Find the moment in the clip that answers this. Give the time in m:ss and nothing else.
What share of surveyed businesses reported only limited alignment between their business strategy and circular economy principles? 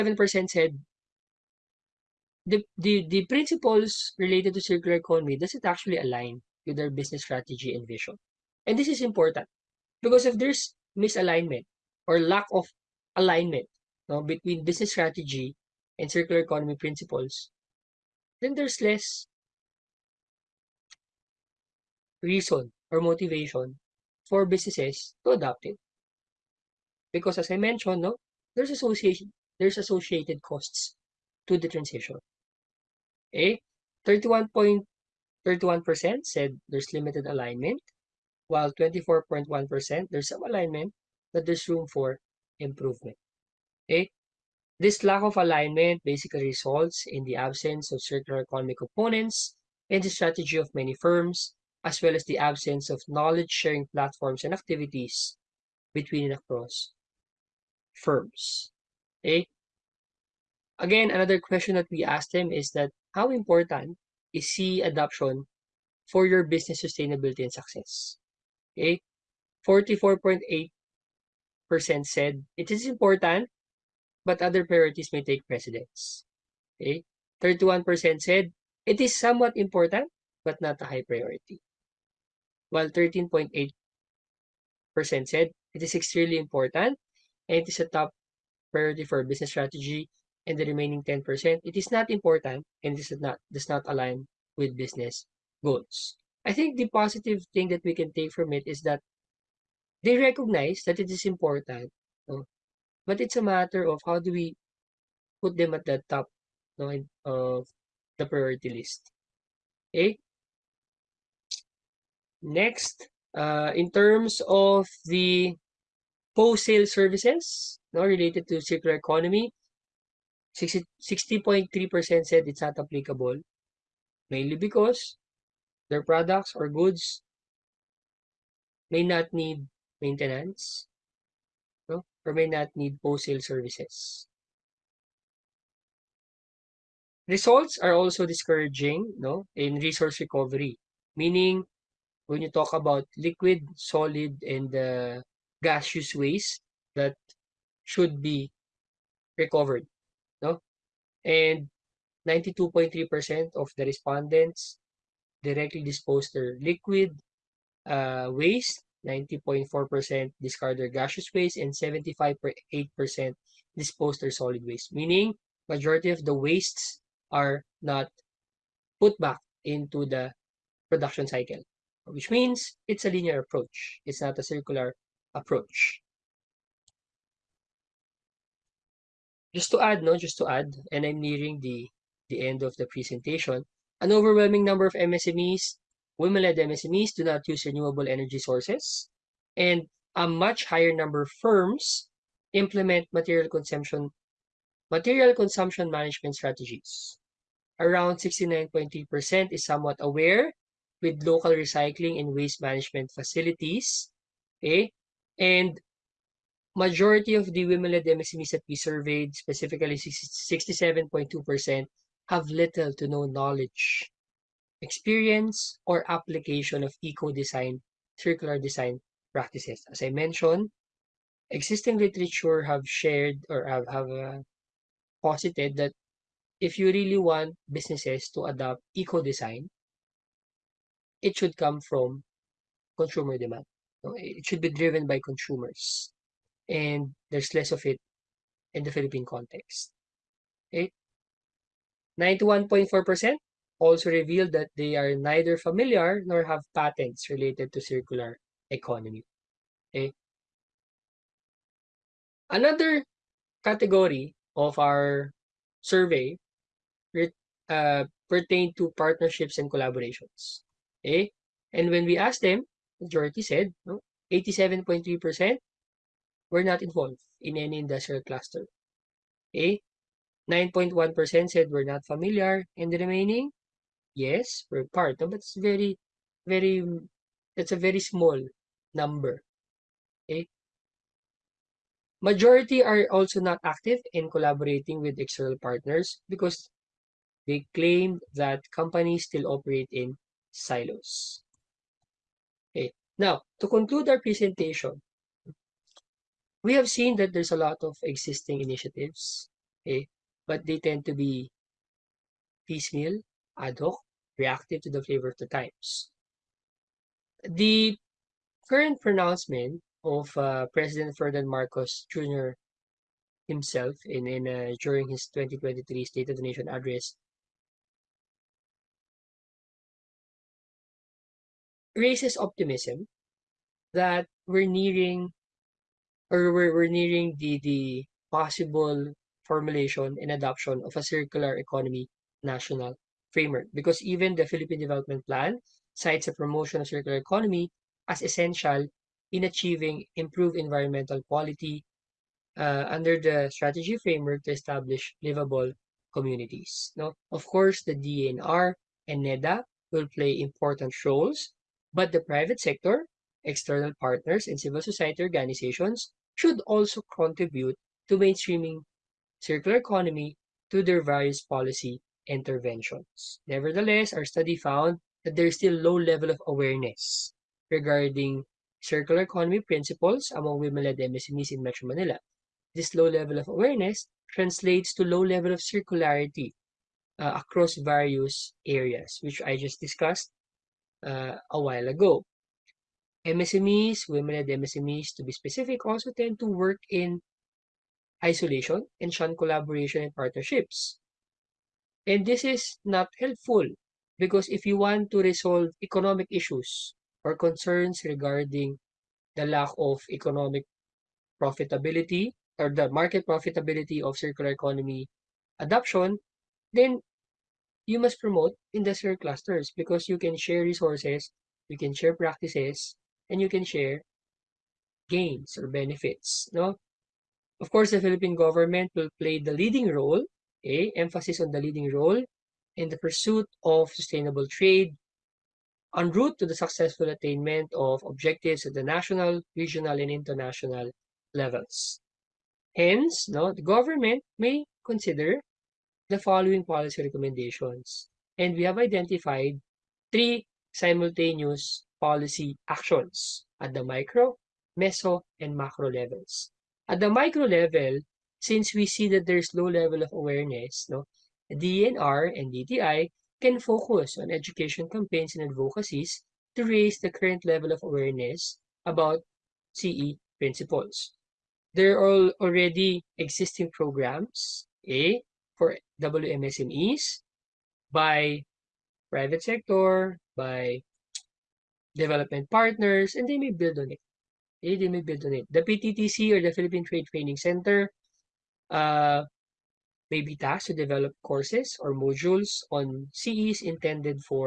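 0:34.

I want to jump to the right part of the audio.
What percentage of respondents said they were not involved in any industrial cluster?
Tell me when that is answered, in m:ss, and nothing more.
4:24.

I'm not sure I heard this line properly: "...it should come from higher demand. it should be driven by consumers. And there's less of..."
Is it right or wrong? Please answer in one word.
wrong.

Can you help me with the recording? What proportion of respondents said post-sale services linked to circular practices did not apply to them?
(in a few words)
60.3%.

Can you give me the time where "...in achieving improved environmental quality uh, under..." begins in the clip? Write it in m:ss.
5:39.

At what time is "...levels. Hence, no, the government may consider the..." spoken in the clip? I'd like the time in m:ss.
7:11.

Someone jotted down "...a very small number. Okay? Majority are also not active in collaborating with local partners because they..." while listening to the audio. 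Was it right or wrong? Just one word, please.
wrong.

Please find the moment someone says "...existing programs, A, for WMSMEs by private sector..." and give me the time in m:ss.
7:43.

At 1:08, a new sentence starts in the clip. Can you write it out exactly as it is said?
44.8% said it is important, but other priorities may take precedence.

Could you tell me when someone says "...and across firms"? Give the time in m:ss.
0:56.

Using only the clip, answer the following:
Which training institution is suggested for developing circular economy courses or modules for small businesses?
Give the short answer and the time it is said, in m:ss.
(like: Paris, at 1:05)
Philippine Trade Training Center, at 7:56.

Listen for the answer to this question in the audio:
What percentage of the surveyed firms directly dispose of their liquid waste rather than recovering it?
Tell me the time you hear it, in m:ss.
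2:32.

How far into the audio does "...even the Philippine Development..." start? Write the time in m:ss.
5:34.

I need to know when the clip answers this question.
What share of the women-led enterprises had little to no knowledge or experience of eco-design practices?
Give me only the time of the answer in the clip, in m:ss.
3:29.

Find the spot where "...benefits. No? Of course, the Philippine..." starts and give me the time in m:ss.
6:55.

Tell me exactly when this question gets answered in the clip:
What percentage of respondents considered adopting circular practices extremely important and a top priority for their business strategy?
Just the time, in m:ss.
1:22.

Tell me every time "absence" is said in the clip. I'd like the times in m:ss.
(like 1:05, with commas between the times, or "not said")
0:47, 0:52.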